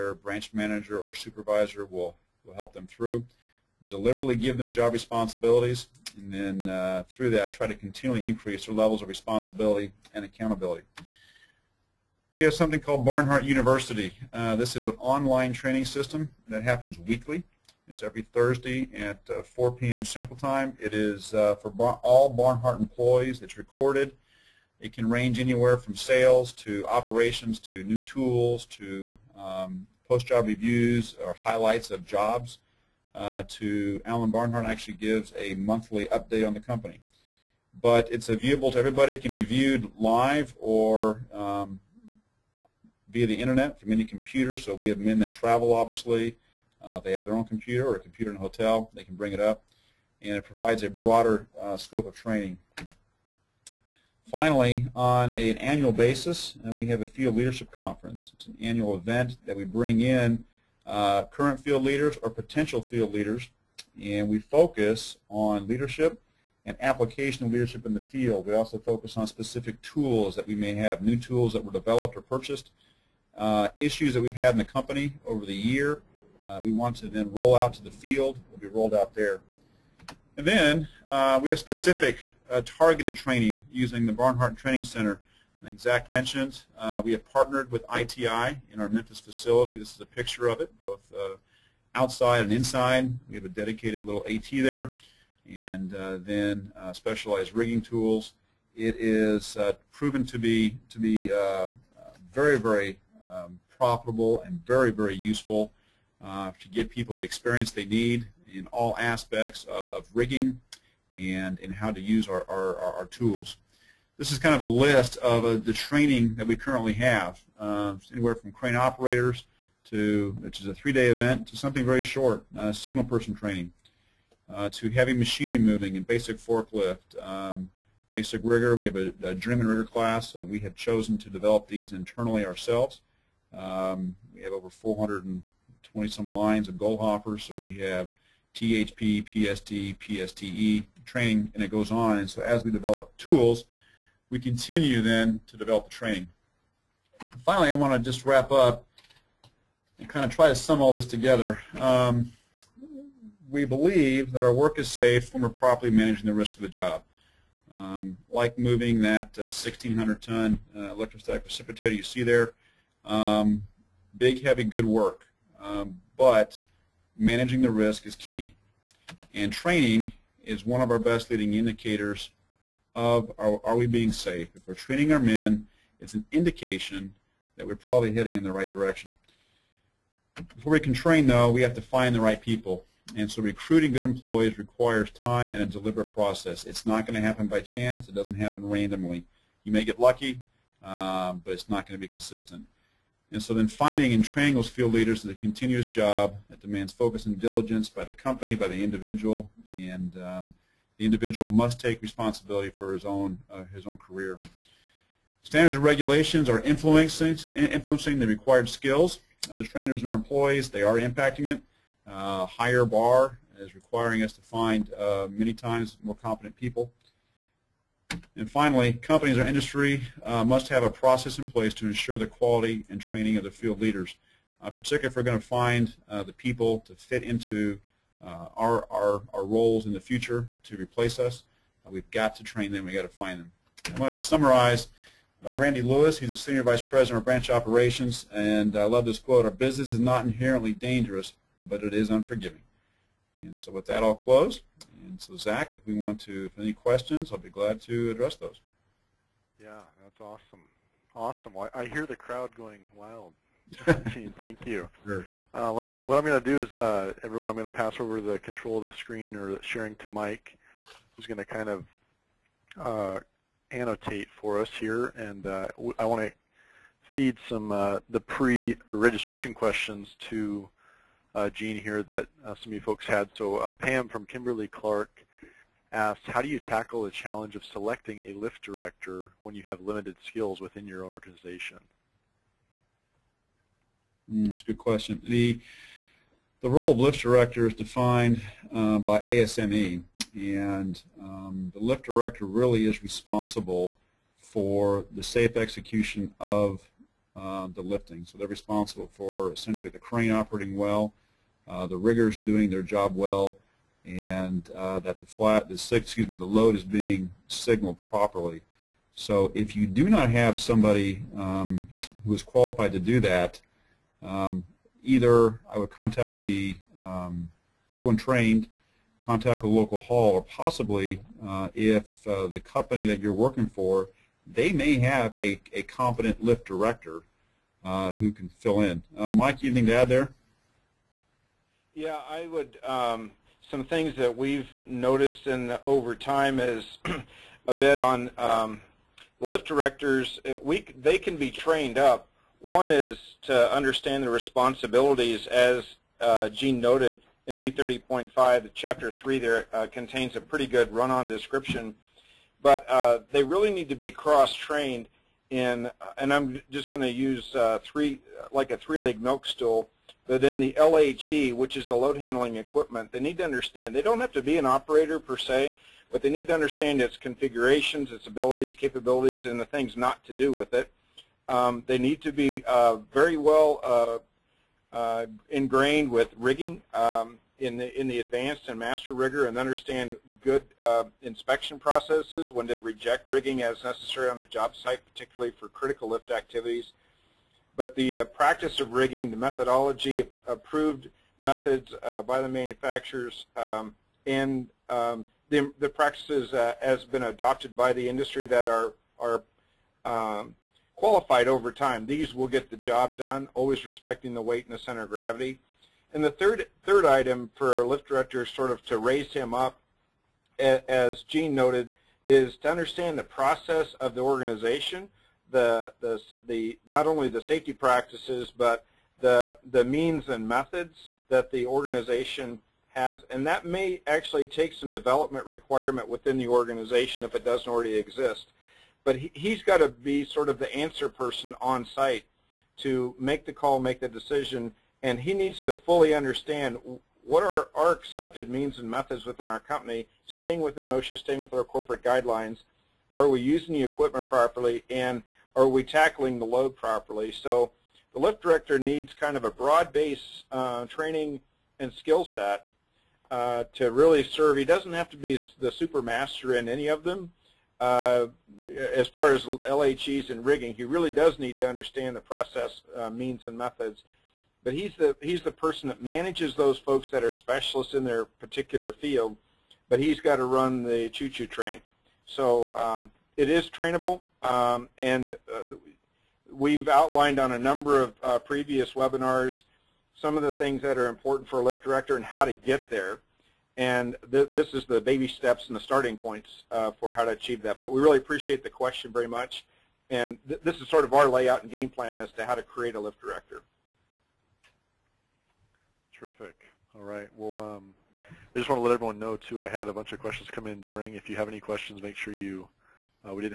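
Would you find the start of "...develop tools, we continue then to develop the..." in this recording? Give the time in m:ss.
2:22.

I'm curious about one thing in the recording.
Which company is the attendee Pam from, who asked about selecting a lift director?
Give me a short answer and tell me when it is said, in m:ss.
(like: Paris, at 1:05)
Kimberly Clark, at 4:34.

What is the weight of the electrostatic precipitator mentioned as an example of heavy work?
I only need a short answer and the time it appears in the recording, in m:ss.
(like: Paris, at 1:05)
1,600 tons, at 2:39.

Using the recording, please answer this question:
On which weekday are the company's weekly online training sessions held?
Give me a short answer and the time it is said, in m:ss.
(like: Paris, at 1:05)
Thursday, at 0:18.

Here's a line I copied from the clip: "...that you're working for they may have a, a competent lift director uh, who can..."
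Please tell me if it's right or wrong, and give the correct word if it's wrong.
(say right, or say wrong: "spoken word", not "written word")
right.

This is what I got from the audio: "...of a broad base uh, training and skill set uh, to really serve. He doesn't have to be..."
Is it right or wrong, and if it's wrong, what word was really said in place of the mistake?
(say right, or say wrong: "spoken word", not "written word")
right.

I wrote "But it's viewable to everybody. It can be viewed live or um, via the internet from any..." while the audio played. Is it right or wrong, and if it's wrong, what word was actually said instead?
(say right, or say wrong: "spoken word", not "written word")
right.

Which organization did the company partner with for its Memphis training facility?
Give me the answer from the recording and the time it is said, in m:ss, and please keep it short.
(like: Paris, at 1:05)
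ITI, at 1:27.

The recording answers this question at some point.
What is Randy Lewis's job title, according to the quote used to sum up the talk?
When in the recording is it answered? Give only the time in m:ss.
3:56.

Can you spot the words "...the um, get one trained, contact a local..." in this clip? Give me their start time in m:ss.
5:16.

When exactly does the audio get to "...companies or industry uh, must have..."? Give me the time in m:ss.
3:38.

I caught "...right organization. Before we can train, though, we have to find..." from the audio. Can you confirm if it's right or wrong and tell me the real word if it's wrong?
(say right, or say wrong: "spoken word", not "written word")
wrong: "direction", not "organization".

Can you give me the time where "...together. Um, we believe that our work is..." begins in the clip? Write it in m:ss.
2:31.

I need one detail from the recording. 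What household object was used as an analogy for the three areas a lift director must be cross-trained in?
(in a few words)
Milk stool.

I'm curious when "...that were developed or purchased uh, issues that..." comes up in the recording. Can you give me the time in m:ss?
1:11.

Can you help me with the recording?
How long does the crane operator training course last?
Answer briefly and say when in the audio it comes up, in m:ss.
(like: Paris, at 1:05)
3 days, at 2:00.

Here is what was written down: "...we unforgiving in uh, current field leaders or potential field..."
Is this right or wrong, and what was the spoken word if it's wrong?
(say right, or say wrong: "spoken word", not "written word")
wrong: "bring", not "unforgiving".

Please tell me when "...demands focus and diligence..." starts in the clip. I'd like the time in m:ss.
3:16.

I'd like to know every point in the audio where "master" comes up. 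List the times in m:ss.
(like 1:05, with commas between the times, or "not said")
6:18, 7:36.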